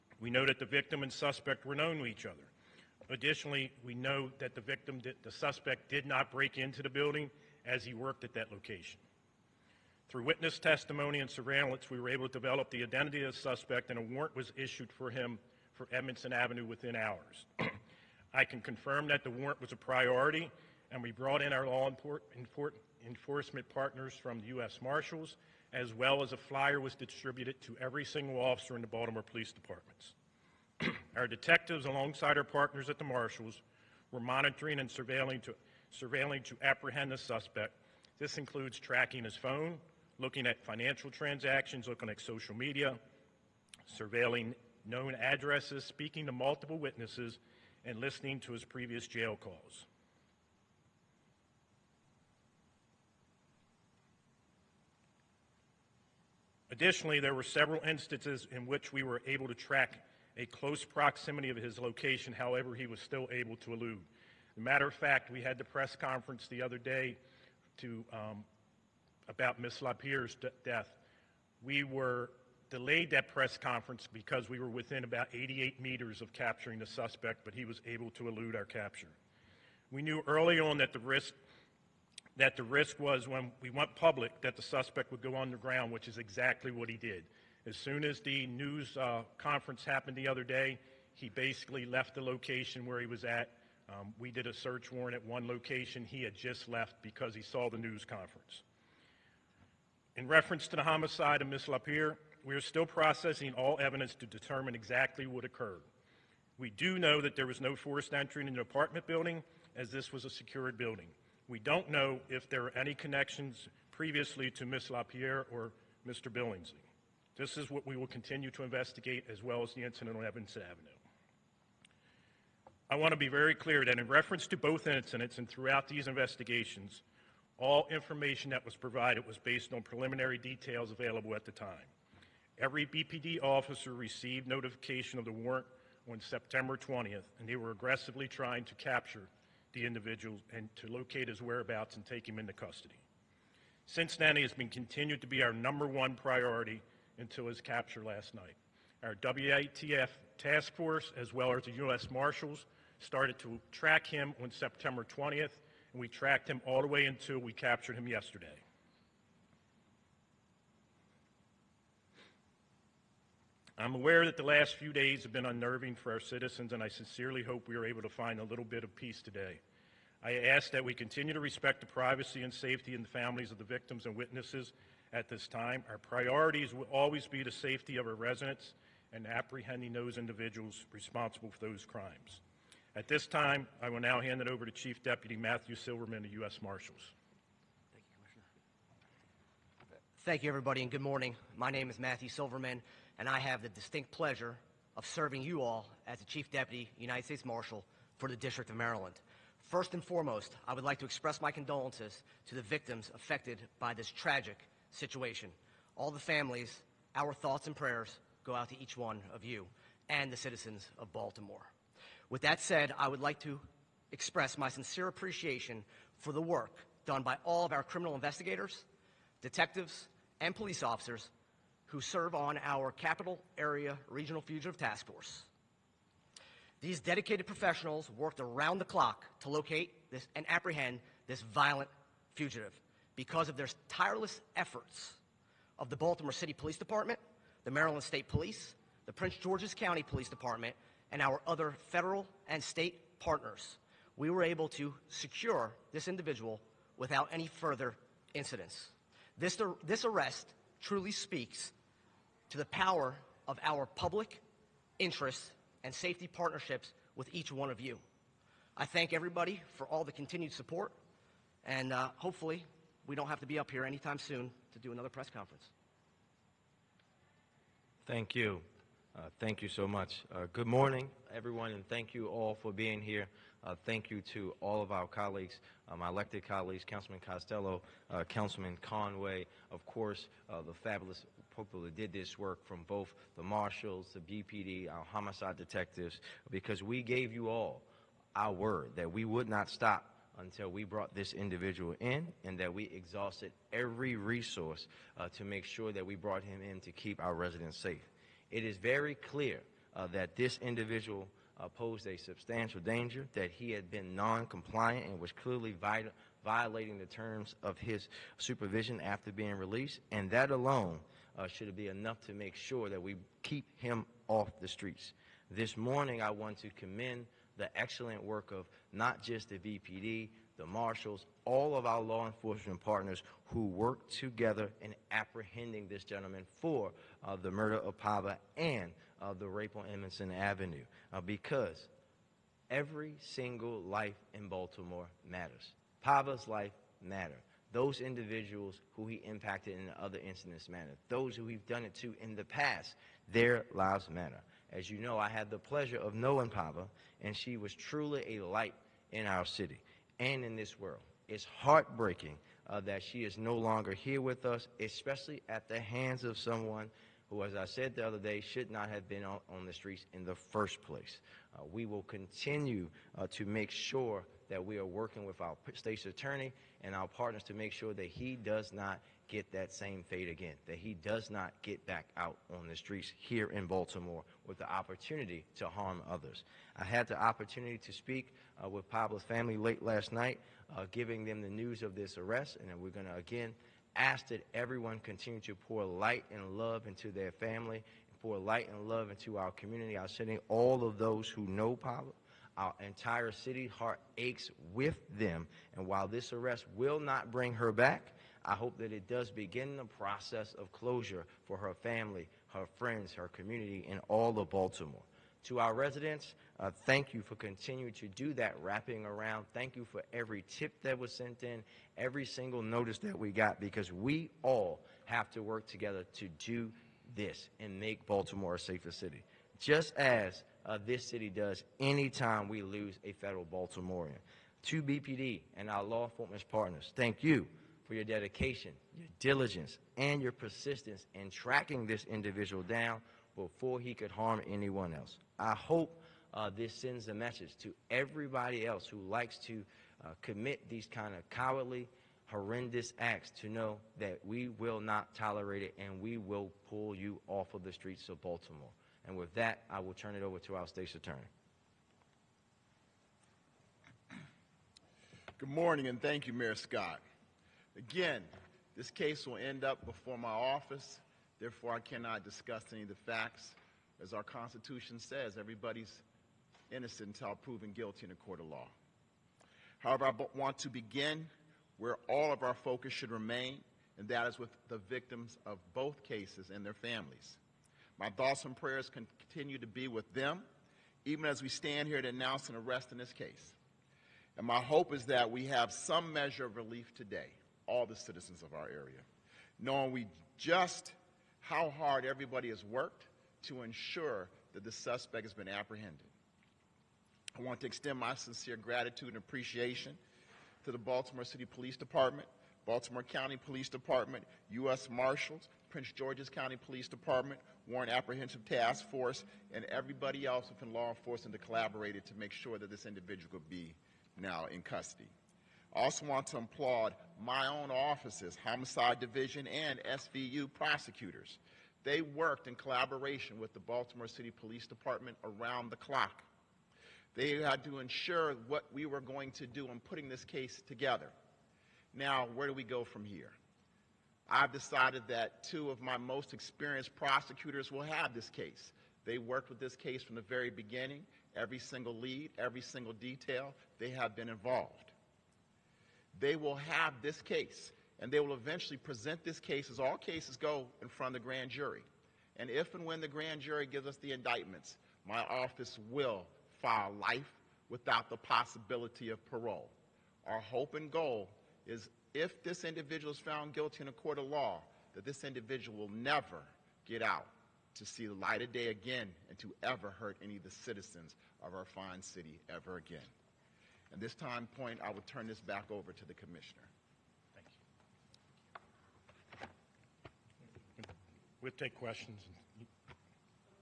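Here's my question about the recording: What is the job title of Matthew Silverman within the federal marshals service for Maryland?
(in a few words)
Chief Deputy United States Marshal.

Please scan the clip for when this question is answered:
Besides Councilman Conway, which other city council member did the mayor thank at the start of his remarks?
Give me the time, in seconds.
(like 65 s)
276 s.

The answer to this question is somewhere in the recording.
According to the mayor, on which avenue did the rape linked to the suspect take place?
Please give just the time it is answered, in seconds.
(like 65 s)
329 s.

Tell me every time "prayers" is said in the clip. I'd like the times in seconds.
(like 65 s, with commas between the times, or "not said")
207 s, 478 s.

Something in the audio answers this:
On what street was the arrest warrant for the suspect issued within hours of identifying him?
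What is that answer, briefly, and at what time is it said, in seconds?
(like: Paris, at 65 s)
Edmondson Avenue, at 15 s.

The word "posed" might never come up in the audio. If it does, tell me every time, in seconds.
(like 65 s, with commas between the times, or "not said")
301 s.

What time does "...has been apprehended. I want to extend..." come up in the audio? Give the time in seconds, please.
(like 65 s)
495 s.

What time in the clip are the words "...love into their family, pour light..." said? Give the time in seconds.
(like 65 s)
386 s.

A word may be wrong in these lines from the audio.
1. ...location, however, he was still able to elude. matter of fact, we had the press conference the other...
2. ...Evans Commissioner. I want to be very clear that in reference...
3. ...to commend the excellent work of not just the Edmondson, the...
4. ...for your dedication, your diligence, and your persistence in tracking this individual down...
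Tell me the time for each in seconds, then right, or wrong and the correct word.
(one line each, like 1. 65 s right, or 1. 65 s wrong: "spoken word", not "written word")
1. 61 s right
2. 120 s wrong: "Avenue", not "Commissioner"
3. 316 s wrong: "BPD", not "Edmondson"
4. 427 s right.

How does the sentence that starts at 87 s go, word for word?
As soon as the news uh, conference happened the other day, he basically left the location where he was at.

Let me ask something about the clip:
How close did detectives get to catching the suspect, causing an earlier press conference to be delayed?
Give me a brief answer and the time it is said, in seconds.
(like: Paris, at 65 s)
88 meters, at 75 s.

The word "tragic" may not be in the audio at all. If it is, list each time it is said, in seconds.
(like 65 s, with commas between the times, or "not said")
204 s.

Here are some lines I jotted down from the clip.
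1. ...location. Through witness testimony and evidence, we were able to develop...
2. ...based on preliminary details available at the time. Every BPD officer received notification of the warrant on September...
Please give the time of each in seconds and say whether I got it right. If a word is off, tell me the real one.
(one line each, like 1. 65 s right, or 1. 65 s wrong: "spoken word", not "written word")
1. 8 s wrong: "surveillance", not "evidence"
2. 129 s right.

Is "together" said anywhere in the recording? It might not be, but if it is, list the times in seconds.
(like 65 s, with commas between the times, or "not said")
324 s, 415 s, 530 s.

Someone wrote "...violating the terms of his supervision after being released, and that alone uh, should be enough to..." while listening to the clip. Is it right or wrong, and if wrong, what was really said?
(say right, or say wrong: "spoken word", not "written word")
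right.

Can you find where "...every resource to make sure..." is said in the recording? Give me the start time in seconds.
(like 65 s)
293 s.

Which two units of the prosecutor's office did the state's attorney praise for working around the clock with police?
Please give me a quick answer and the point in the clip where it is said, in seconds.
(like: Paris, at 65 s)
Homicide Division and SVU, at 518 s.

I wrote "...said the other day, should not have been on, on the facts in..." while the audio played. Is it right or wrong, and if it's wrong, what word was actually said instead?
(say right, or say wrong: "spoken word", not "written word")
wrong: "streets", not "facts".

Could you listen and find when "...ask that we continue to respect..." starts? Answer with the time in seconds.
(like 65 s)
170 s.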